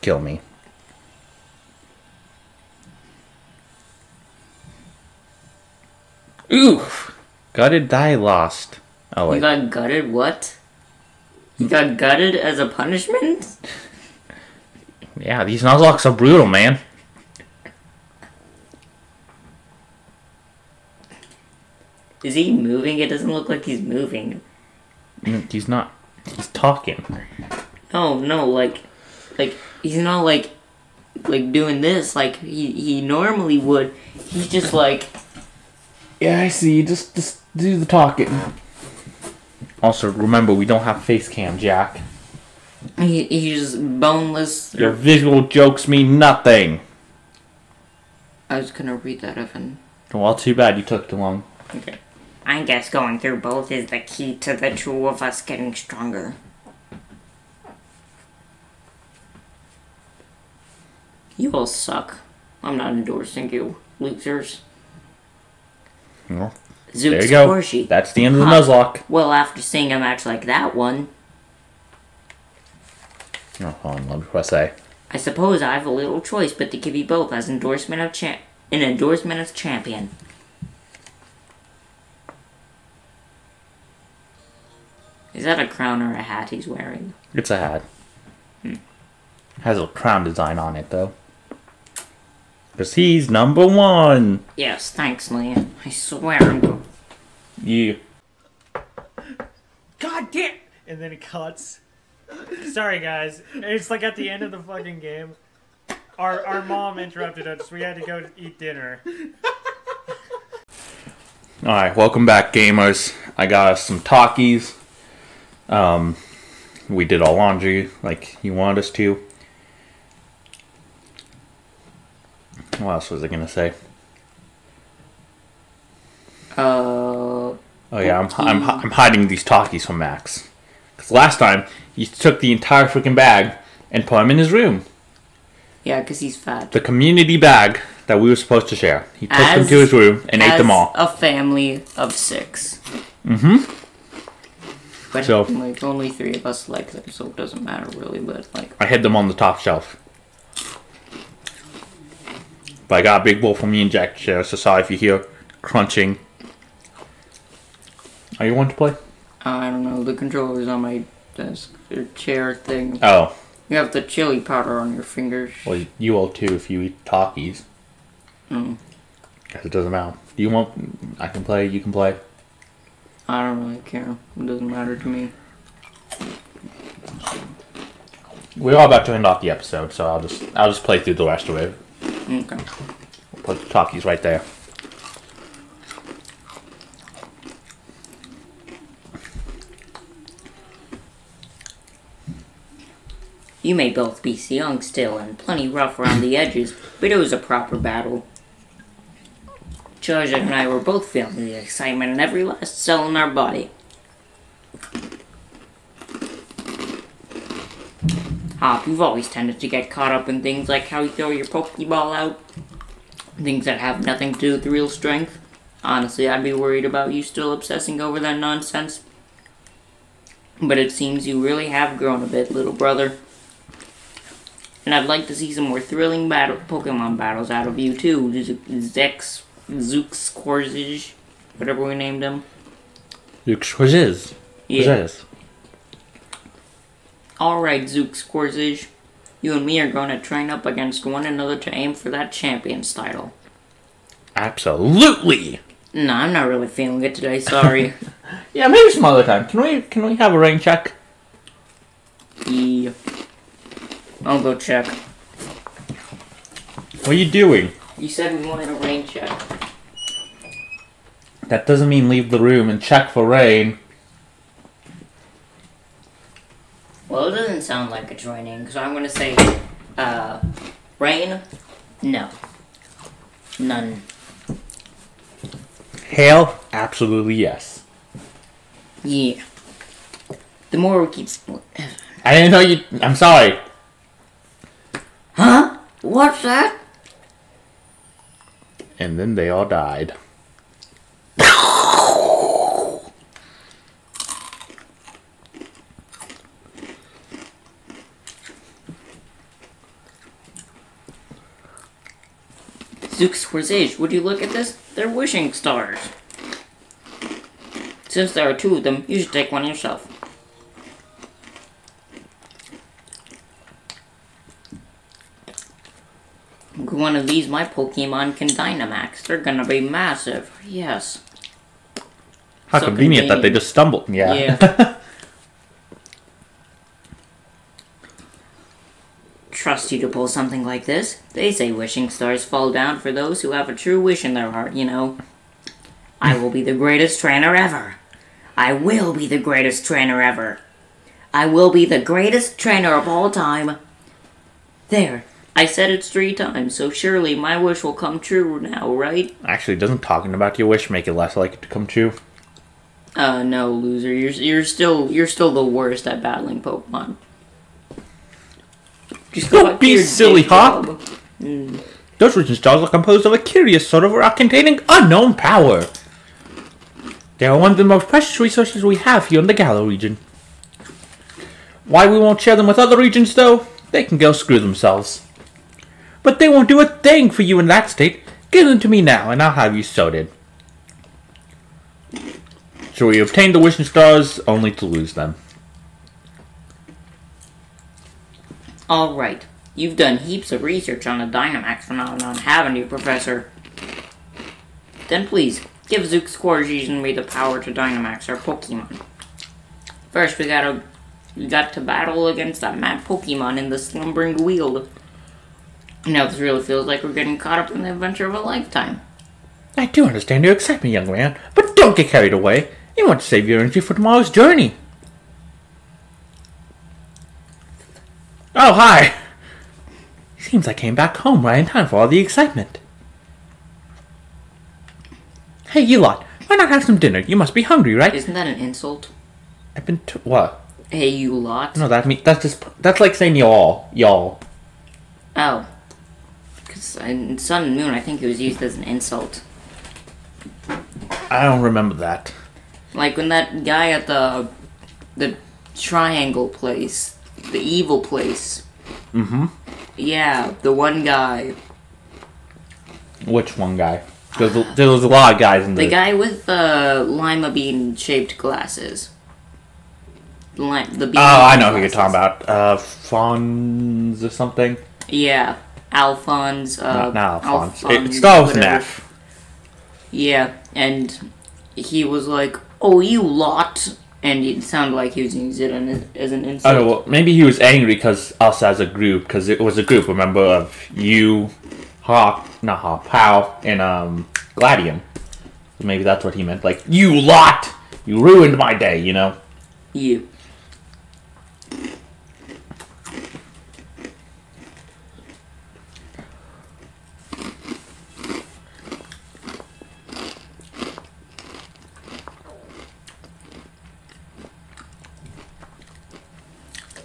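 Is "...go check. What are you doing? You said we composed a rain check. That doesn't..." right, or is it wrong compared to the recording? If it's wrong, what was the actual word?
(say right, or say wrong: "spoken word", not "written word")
wrong: "wanted", not "composed".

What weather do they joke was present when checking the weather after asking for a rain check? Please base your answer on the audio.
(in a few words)
Hail.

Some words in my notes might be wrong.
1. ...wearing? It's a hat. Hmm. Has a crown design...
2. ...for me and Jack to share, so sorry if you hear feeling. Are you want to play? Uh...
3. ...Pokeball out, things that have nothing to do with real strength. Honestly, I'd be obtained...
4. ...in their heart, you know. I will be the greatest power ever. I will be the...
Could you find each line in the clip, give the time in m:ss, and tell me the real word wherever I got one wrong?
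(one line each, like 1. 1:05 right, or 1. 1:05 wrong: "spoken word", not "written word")
1. 1:26 right
2. 2:33 wrong: "crunching", not "feeling"
3. 3:31 wrong: "worried", not "obtained"
4. 5:34 wrong: "trainer", not "power".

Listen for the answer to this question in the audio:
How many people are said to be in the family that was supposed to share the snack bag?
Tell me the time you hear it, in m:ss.
2:22.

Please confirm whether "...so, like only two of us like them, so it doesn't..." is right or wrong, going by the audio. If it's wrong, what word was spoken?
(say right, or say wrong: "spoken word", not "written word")
wrong: "three", not "two".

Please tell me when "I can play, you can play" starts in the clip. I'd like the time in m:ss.
2:51.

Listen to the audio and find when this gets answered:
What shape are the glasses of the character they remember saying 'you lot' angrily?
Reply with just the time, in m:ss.
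7:37.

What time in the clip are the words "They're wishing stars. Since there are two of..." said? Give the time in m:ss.
5:04.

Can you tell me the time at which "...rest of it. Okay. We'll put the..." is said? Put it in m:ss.
3:01.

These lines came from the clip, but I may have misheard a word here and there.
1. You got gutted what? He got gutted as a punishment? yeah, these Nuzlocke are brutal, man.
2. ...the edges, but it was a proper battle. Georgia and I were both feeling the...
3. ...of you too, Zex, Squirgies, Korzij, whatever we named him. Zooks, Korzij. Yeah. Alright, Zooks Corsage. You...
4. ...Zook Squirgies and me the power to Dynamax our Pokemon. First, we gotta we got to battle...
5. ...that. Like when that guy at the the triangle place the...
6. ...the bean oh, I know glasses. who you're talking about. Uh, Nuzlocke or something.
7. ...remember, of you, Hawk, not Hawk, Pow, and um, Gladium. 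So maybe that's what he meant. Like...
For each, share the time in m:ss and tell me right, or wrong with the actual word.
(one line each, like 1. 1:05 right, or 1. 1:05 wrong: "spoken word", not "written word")
1. 0:09 right
2. 3:16 right
3. 3:47 wrong: "Zooks", not "Squirgies"
4. 6:36 right
5. 7:21 right
6. 7:40 wrong: "Fons", not "Nuzlocke"
7. 8:00 right.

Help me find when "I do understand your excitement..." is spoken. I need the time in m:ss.
6:49.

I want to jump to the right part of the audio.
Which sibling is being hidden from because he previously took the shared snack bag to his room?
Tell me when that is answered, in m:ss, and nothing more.
2:09.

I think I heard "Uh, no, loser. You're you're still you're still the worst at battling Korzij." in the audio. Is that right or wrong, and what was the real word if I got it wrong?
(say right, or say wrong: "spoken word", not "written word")
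wrong: "Pokemon", not "Korzij".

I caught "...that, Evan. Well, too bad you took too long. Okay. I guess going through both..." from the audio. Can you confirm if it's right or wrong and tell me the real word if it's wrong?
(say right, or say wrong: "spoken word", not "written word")
right.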